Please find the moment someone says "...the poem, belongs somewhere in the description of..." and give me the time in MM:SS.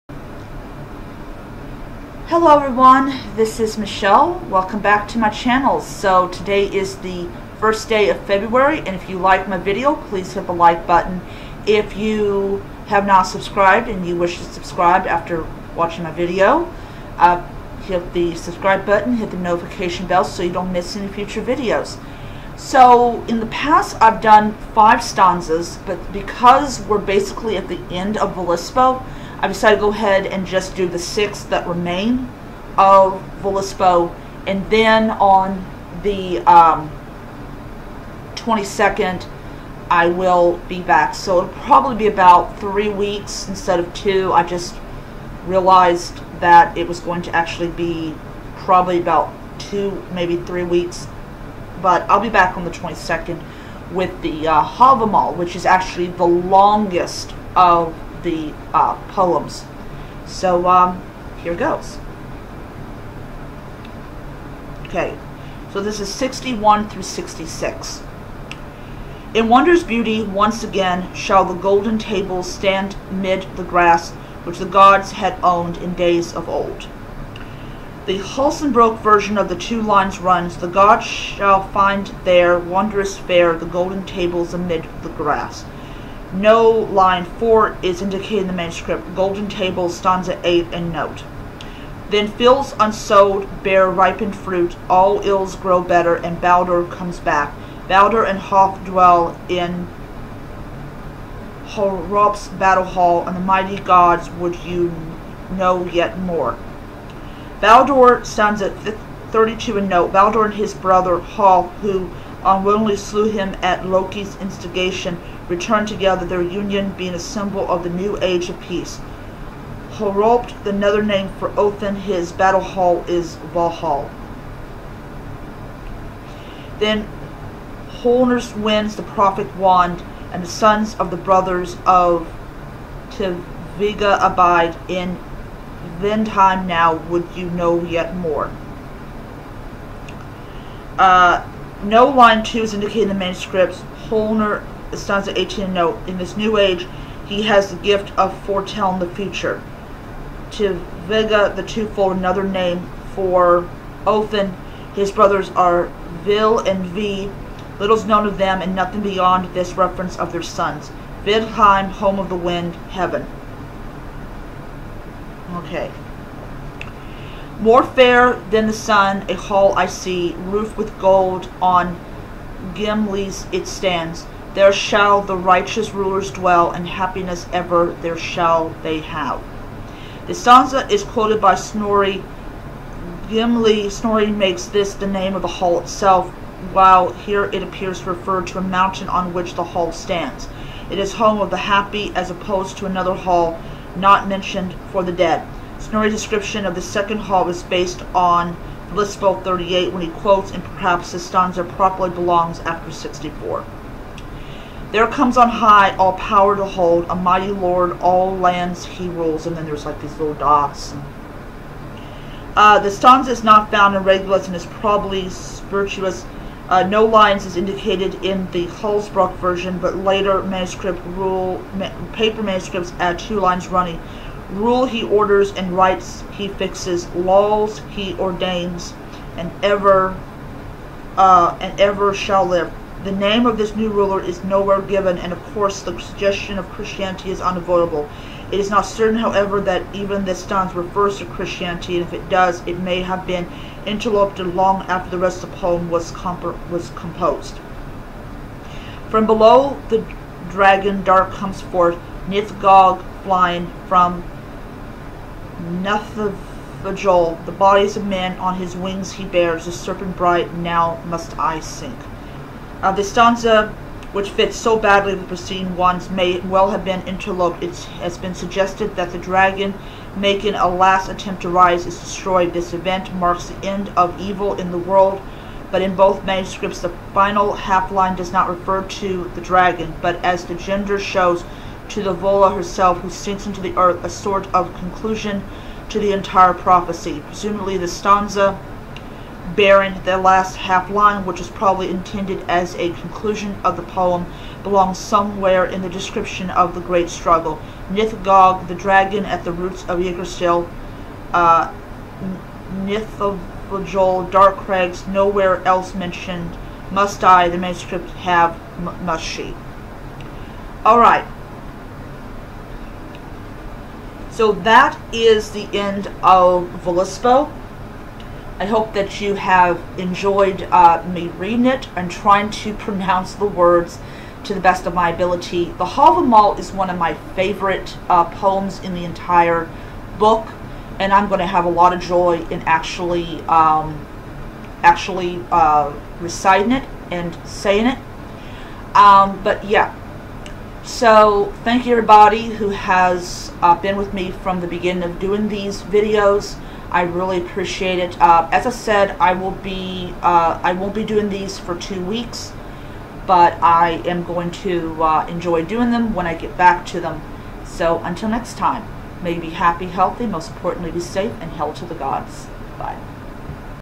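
04:53.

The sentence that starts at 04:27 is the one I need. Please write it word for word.
It has been suggested that the dragon, making a last attempt to rise, is destroyed.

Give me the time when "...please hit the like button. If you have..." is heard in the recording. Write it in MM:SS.
00:10.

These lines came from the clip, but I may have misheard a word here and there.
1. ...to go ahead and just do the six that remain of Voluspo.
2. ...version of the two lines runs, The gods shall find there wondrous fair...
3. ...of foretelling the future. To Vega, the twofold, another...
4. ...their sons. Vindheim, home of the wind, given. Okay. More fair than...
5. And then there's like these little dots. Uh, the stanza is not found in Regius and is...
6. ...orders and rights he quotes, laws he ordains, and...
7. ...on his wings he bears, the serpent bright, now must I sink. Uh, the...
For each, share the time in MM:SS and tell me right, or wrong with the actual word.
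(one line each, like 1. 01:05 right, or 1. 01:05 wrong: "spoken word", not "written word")
1. 00:29 right
2. 01:18 right
3. 02:28 right
4. 02:40 wrong: "heaven", not "given"
5. 03:29 right
6. 03:45 wrong: "fixes", not "quotes"
7. 04:18 right.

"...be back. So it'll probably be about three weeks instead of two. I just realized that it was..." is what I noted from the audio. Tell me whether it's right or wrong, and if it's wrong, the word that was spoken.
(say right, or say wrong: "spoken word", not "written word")
right.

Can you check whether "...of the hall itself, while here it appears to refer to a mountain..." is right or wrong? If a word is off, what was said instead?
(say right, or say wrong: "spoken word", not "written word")
right.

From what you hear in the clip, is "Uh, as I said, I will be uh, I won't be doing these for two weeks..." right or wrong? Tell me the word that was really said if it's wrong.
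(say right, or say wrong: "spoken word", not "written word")
right.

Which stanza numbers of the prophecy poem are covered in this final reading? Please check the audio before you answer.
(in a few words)
61 through 66.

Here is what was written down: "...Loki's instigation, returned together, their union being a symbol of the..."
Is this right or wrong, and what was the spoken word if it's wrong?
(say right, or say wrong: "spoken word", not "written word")
right.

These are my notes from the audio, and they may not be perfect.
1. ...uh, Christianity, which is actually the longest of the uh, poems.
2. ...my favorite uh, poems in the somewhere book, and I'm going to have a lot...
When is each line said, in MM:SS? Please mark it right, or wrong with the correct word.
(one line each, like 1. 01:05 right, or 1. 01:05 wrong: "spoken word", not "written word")
1. 00:54 wrong: "Havamal", not "Christianity"
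2. 05:26 wrong: "entire", not "somewhere".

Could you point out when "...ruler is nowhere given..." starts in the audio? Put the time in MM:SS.
03:53.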